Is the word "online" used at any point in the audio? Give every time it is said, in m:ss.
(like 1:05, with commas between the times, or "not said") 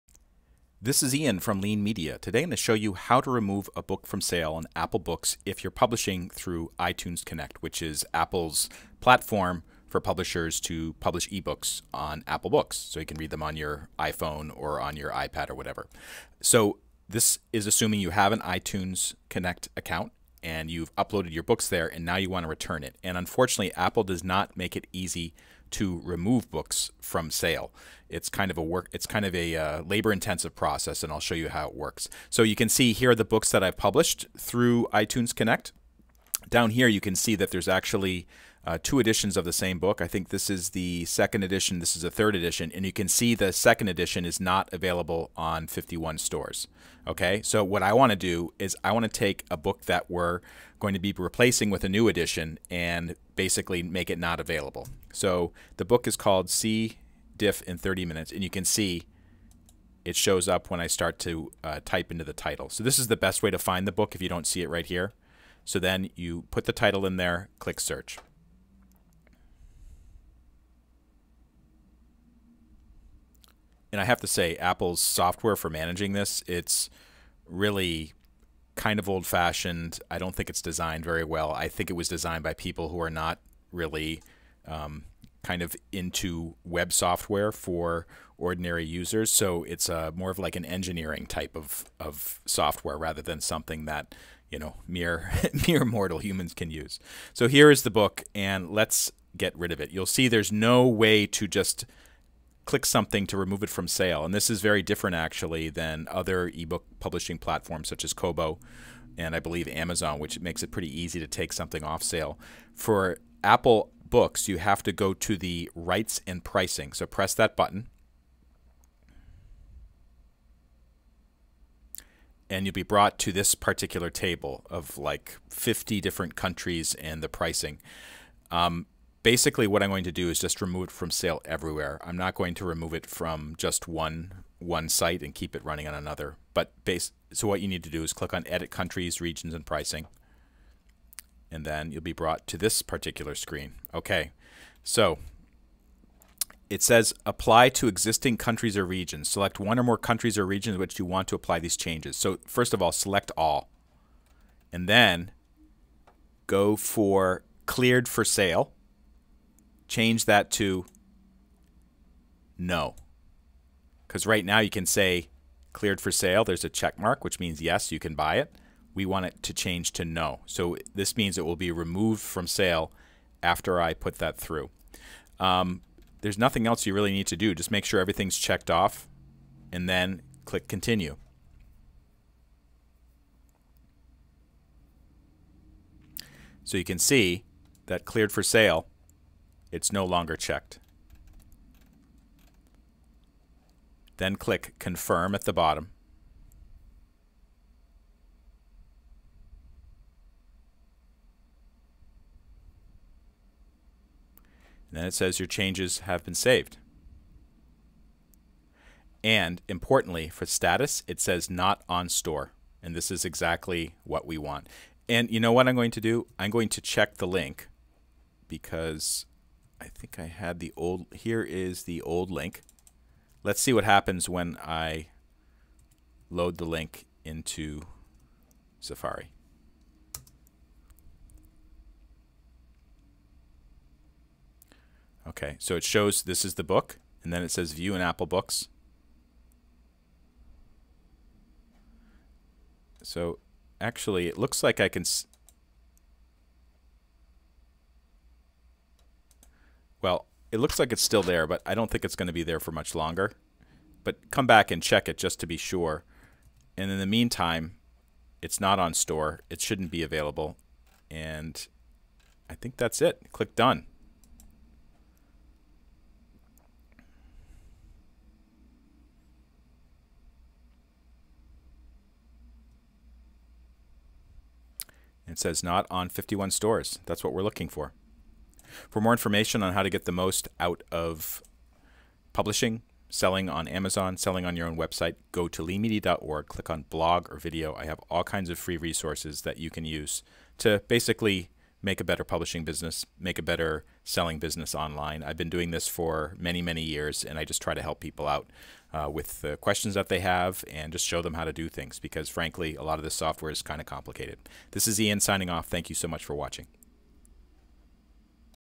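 4:54.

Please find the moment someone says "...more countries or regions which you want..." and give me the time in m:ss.
2:29.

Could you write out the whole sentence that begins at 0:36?
Down here you can see that there's actually uh, two editions of the same book.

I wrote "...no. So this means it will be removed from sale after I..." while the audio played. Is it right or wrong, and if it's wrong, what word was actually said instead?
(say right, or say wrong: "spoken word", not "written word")
right.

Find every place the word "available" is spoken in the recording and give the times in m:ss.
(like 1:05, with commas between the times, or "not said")
0:44, 0:54, 4:20.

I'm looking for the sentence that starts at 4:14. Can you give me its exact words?
But come back and check it just to be sure.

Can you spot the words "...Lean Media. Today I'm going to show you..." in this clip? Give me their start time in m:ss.
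0:01.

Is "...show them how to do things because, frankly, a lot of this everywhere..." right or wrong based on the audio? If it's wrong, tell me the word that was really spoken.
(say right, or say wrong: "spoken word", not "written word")
wrong: "software", not "everywhere".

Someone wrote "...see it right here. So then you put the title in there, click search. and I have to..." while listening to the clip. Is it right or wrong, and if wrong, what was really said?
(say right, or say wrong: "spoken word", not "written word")
right.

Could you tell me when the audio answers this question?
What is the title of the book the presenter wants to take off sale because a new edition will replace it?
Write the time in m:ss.
0:56.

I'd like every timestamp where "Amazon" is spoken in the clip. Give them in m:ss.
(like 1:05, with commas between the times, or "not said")
1:49, 4:43.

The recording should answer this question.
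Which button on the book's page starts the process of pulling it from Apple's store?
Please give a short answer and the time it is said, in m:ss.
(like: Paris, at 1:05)
rights and pricing, at 1:55.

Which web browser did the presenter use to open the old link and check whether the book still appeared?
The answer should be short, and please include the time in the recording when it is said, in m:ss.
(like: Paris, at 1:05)
Safari, at 3:48.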